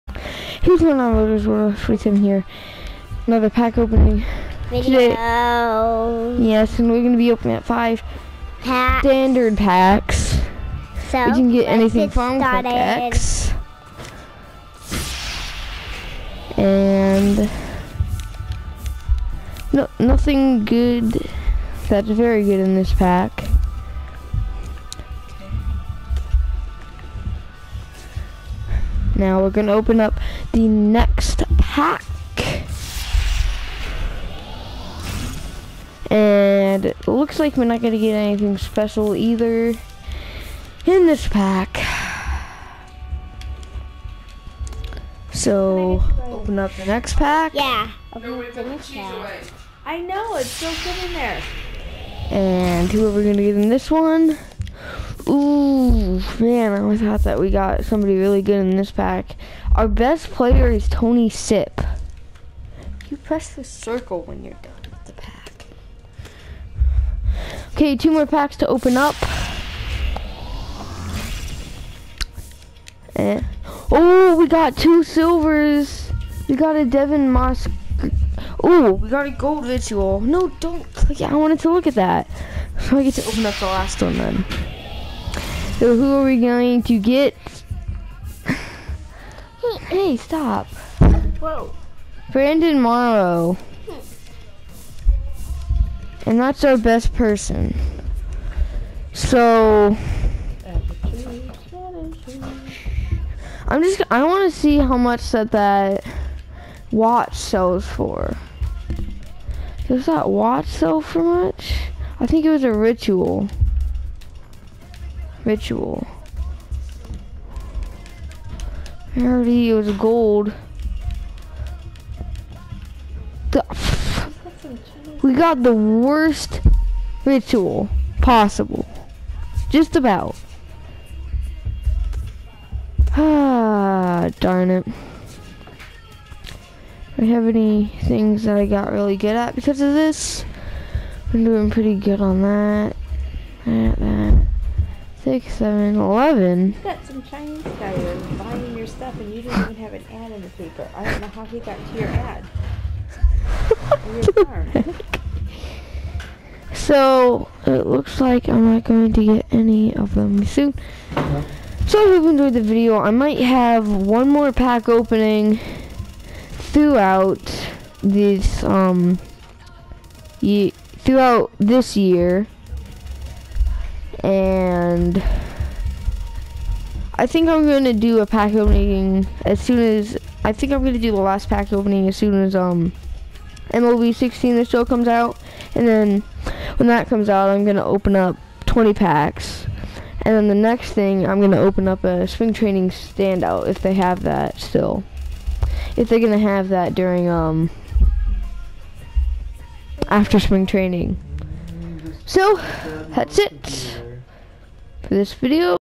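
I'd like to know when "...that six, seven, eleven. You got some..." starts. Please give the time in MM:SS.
02:23.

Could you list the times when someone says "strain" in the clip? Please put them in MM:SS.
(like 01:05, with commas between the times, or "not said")
not said.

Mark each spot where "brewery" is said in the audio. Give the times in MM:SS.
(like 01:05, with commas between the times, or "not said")
not said.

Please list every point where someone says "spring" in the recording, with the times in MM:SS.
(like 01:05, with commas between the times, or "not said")
03:12, 03:20.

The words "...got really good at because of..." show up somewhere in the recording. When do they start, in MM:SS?
02:18.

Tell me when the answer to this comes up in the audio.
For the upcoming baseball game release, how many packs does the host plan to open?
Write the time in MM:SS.
03:08.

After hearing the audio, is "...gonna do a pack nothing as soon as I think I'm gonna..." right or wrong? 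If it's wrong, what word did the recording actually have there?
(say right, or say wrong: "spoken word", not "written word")
wrong: "opening", not "nothing".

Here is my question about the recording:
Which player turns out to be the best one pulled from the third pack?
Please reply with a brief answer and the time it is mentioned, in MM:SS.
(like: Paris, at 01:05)
Tony Sipp, at 01:00.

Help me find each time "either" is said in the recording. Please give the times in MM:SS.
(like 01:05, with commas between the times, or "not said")
00:39.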